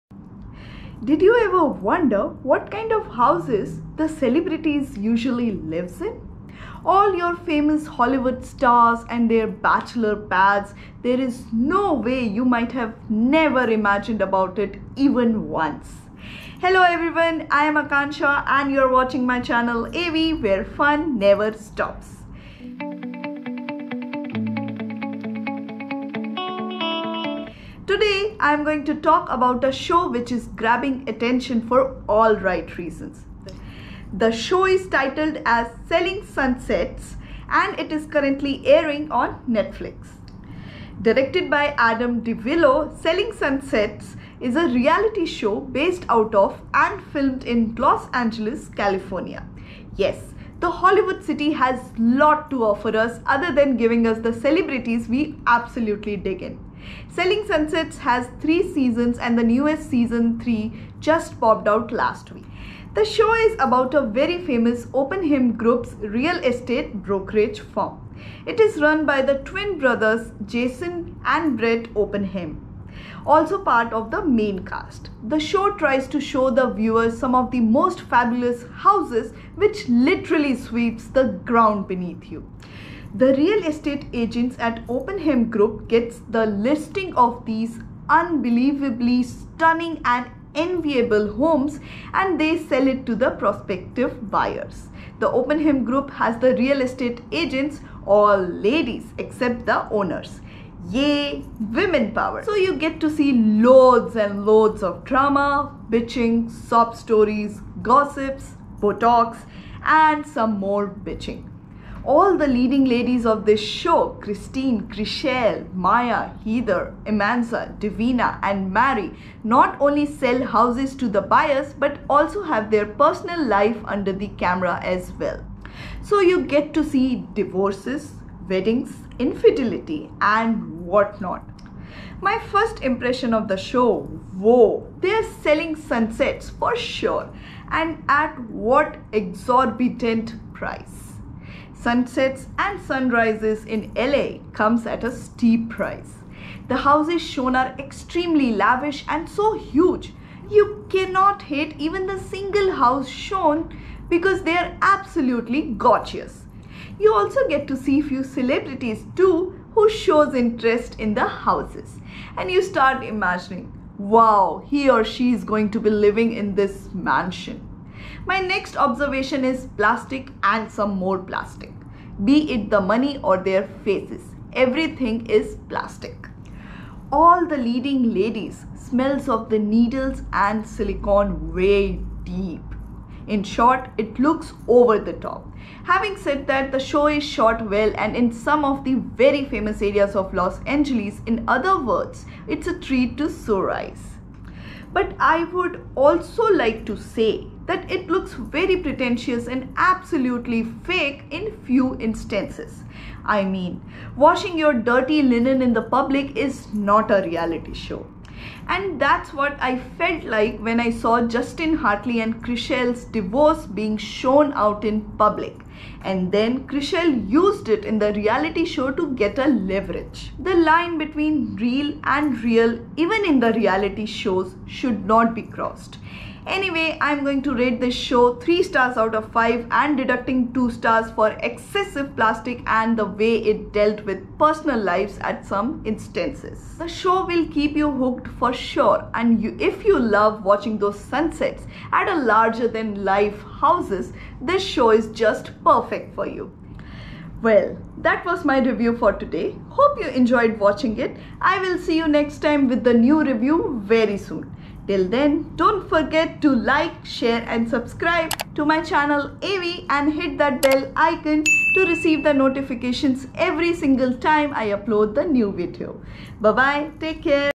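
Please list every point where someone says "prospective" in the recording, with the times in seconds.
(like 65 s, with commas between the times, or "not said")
93 s.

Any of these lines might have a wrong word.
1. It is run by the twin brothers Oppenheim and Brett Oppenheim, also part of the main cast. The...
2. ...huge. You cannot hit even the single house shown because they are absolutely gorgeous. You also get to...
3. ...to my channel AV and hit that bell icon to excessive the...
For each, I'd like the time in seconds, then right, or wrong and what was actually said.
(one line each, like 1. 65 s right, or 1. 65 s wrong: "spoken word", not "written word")
1. 68 s wrong: "Jason", not "Oppenheim"
2. 149 s right
3. 258 s wrong: "receive", not "excessive".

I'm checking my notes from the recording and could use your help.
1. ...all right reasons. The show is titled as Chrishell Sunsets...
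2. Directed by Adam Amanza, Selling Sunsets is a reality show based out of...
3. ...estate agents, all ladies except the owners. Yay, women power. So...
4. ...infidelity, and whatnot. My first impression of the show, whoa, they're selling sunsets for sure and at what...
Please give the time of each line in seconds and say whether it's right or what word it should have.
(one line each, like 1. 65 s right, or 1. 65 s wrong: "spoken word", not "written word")
1. 32 s wrong: "Selling", not "Chrishell"
2. 41 s wrong: "DiVello", not "Amanza"
3. 96 s right
4. 129 s right.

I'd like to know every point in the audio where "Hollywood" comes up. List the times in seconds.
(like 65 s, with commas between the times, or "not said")
7 s, 50 s.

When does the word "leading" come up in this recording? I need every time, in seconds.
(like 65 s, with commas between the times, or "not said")
112 s, 177 s.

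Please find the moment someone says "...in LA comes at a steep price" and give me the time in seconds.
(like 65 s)
143 s.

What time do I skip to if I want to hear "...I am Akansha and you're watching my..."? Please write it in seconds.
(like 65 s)
17 s.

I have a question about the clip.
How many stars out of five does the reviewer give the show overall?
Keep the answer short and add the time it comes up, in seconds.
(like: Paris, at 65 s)
3, at 228 s.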